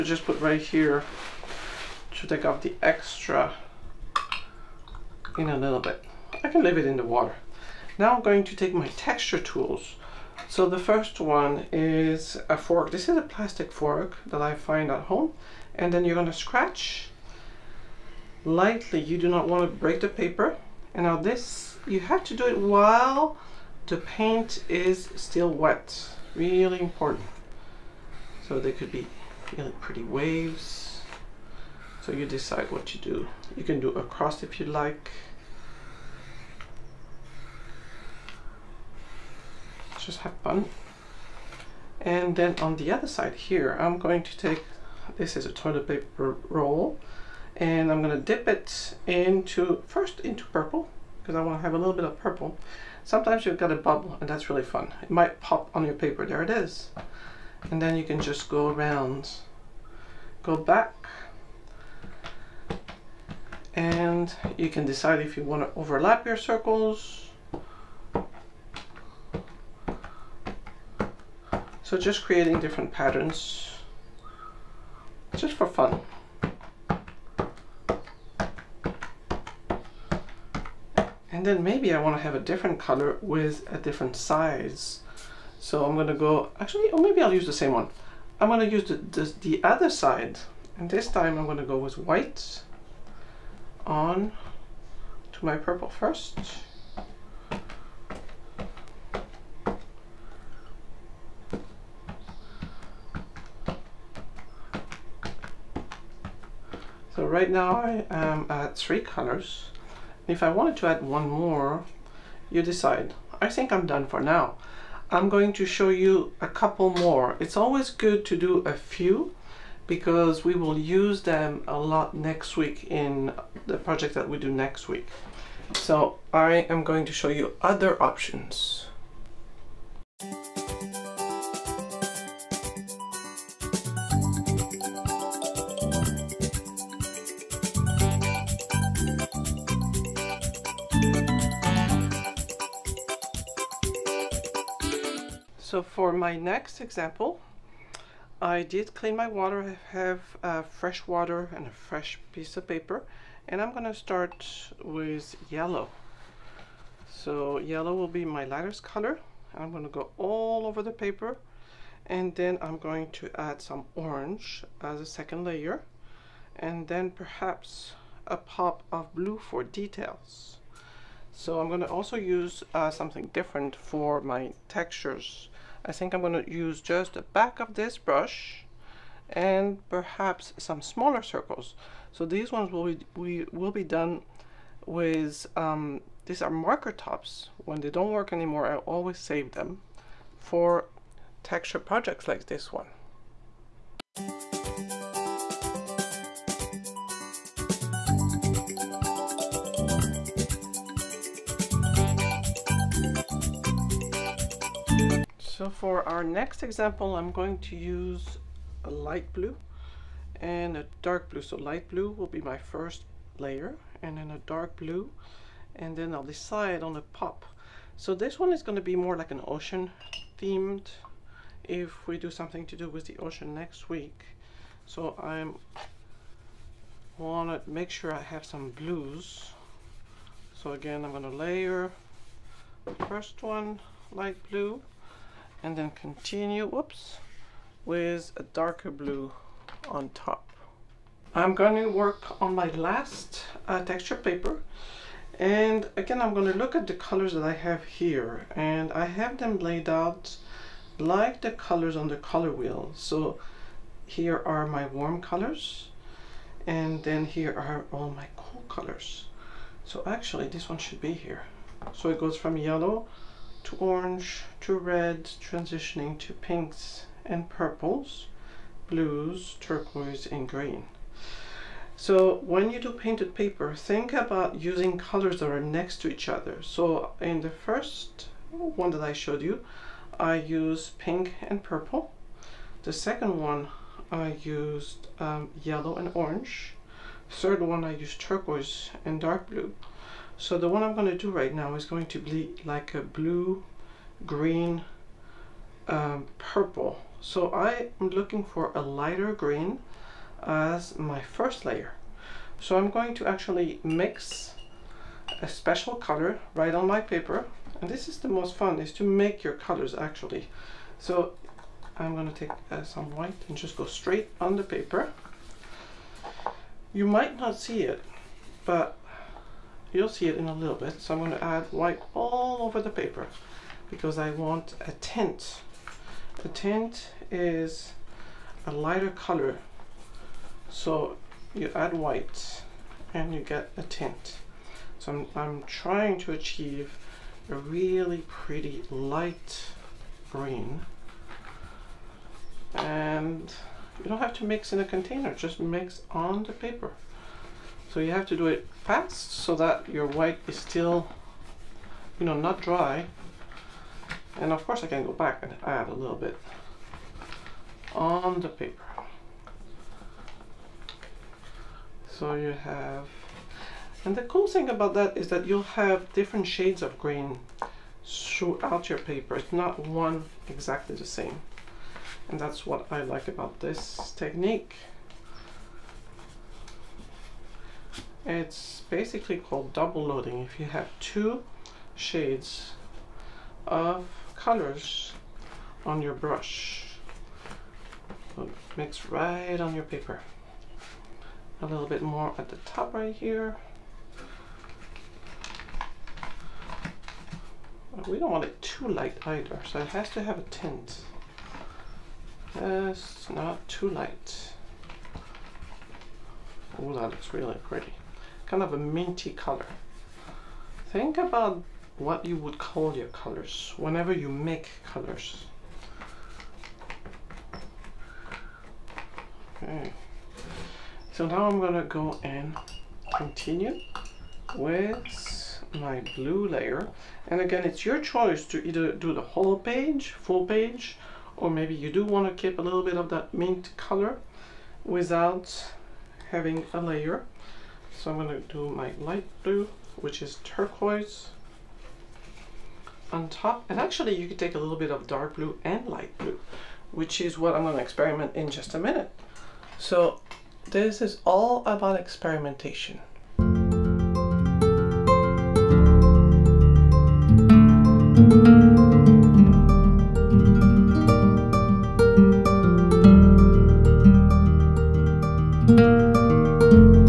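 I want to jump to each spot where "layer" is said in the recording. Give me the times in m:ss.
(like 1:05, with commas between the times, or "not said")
2:45, 3:33, 3:51, 5:01, 7:06, 7:16.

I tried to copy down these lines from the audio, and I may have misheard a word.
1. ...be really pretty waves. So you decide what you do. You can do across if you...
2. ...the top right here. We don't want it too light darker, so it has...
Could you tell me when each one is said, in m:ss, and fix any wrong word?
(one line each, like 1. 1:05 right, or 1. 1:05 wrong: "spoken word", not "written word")
1. 0:28 right
2. 6:32 wrong: "either", not "darker".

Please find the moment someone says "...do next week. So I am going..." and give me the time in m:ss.
2:04.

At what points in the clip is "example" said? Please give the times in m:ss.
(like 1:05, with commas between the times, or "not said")
2:26, 3:26.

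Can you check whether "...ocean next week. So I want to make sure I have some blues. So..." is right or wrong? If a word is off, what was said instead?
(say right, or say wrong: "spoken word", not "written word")
right.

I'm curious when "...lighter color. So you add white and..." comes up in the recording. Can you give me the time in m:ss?
5:28.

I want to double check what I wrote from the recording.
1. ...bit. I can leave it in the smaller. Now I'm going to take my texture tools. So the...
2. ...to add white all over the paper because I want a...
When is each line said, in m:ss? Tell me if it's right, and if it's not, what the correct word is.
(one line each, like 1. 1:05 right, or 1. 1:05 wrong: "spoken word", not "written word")
1. 0:05 wrong: "water", not "smaller"
2. 5:21 right.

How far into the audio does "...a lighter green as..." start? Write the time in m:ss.
4:58.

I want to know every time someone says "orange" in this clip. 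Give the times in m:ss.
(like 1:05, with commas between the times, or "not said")
2:43, 4:23, 4:46.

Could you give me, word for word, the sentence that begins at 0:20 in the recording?
And now this you have to do it while the paint is still wet.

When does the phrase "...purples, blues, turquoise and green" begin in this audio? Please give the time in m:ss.
4:27.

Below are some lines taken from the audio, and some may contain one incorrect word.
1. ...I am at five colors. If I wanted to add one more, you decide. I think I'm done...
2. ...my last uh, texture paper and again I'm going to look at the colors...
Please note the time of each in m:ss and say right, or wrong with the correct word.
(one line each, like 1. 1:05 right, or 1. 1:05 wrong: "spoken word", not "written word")
1. 1:47 wrong: "three", not "five"
2. 4:02 right.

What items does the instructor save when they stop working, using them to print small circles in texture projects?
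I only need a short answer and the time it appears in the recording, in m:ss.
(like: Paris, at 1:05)
marker tops, at 3:06.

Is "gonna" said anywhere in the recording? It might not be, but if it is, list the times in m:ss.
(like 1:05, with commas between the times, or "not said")
0:16, 0:48, 2:33, 2:39, 2:51, 7:01.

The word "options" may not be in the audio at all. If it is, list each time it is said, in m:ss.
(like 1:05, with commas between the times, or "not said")
2:07.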